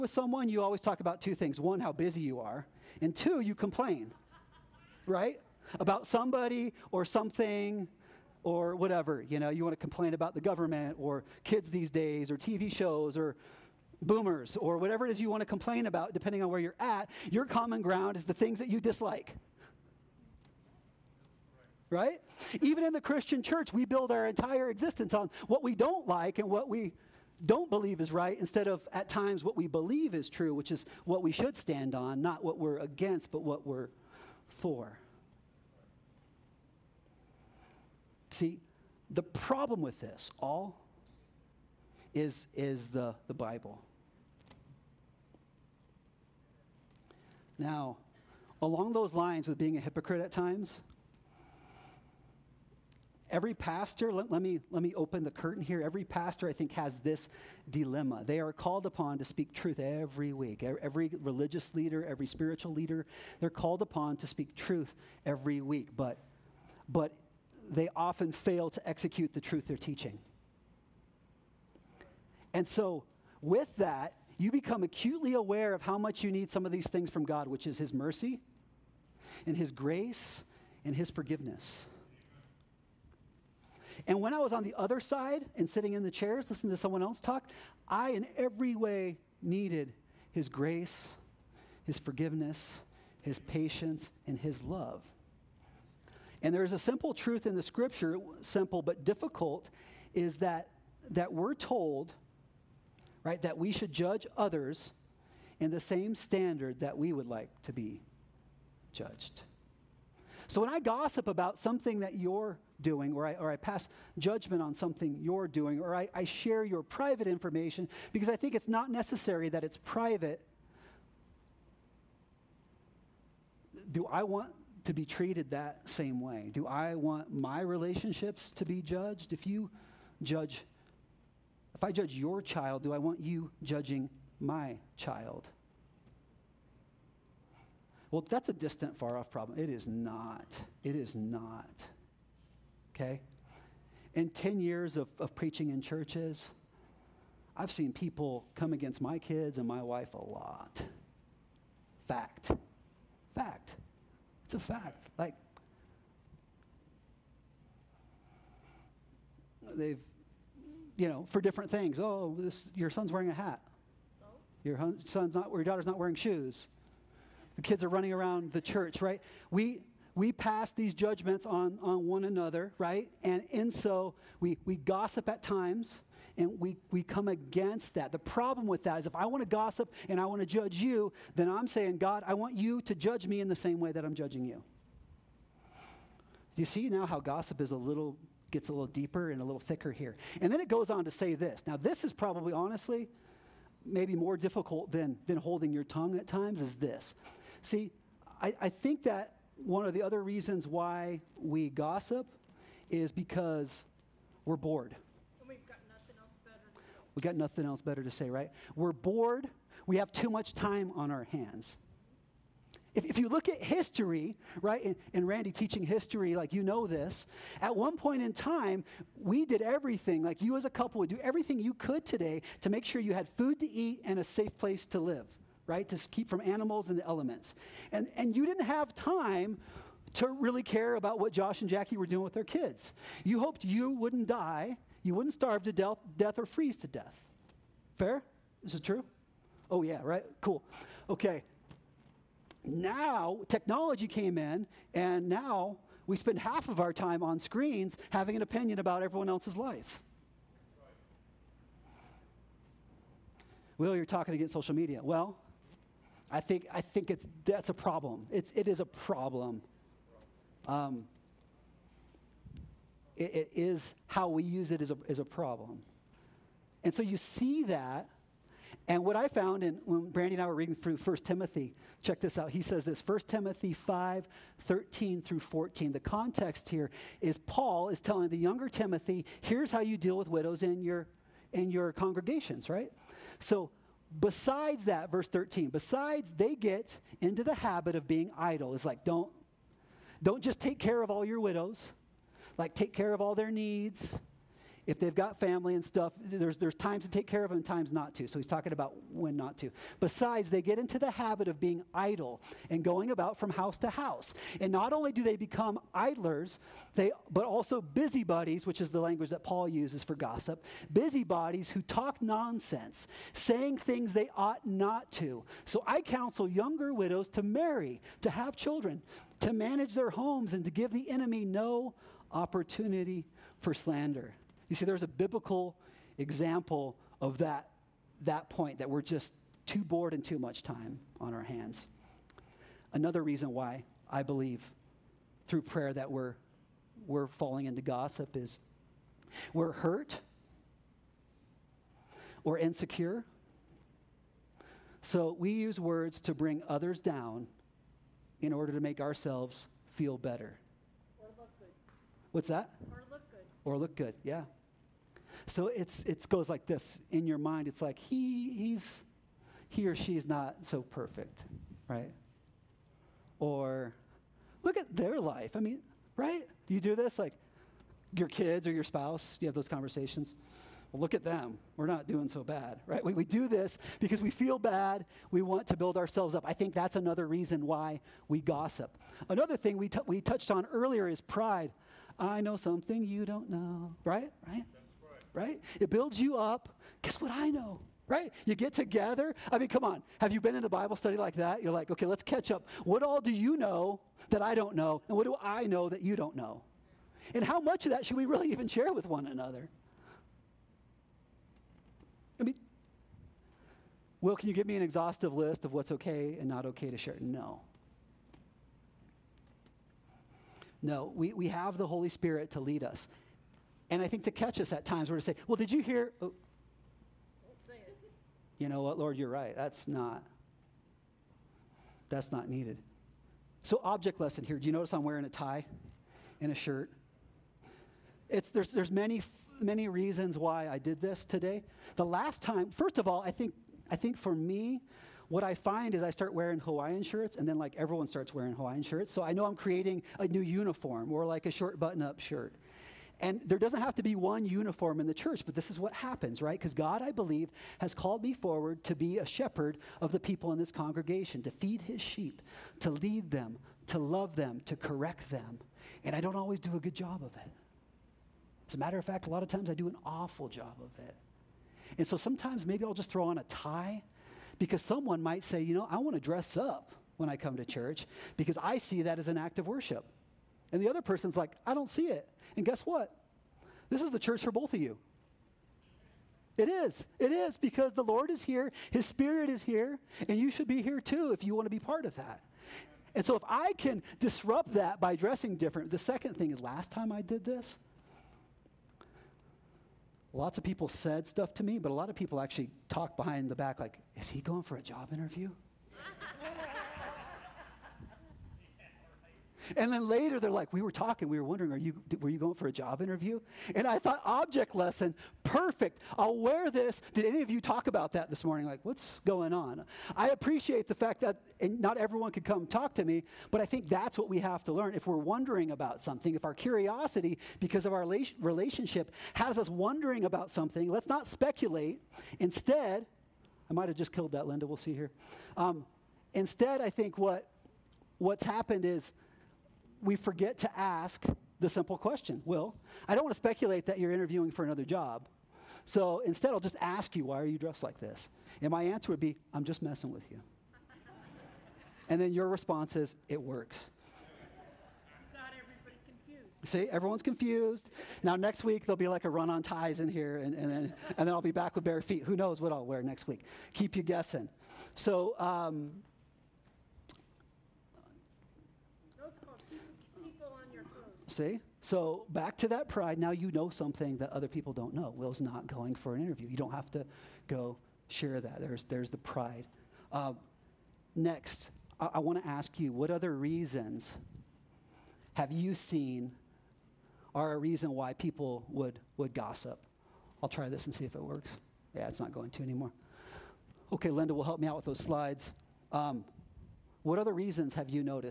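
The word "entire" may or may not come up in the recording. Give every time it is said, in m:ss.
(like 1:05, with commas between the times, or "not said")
0:24.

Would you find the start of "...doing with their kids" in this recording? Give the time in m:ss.
3:52.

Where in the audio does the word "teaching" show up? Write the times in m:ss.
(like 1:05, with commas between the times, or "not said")
1:09, 3:35.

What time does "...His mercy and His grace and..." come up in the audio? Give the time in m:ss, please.
1:17.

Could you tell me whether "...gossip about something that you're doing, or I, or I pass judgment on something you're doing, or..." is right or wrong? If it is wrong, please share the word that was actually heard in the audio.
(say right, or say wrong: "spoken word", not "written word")
right.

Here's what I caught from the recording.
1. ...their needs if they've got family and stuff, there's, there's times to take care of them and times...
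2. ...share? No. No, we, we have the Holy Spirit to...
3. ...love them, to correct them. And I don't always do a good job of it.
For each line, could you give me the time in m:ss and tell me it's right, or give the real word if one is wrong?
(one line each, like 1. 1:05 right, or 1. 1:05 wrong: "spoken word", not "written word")
1. 4:53 right
2. 6:46 right
3. 7:33 right.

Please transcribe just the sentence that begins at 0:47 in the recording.
Now, along those lines with being a hypocrite at times, Every pastor, let, let, me, let me open the curtain here.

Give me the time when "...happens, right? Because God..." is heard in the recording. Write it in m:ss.
7:25.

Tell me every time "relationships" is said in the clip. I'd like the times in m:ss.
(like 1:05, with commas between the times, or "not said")
2:07, 8:38.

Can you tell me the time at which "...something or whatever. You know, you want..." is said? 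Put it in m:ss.
0:07.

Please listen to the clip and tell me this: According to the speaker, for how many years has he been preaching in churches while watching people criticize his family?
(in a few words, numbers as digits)
10.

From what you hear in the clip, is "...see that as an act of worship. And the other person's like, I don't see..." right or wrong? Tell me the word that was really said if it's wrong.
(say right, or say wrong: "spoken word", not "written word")
right.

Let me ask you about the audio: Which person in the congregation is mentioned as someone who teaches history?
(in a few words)
Randy.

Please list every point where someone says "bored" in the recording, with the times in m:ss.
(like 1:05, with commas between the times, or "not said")
3:24, 3:28, 5:29.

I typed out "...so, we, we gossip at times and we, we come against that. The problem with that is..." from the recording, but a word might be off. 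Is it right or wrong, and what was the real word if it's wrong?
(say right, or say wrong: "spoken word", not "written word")
right.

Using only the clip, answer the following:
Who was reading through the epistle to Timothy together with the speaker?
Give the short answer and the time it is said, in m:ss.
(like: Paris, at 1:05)
Brandy, at 4:30.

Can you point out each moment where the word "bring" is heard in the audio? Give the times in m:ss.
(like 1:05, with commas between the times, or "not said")
5:46.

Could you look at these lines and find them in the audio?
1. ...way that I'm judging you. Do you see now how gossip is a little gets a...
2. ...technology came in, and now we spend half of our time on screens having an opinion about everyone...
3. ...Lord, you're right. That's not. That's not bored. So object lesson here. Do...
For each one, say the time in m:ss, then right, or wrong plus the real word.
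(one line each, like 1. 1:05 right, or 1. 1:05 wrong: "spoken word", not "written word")
1. 3:03 right
2. 4:03 right
3. 6:58 wrong: "needed", not "bored".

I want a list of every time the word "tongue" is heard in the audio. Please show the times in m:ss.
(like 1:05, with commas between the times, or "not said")
3:15.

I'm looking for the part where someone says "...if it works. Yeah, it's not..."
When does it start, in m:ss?
9:41.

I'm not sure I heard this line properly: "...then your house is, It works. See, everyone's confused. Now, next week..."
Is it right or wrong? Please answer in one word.
wrong.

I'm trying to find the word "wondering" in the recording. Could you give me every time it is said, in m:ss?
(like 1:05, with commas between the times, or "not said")
8:21, 8:35, 8:39.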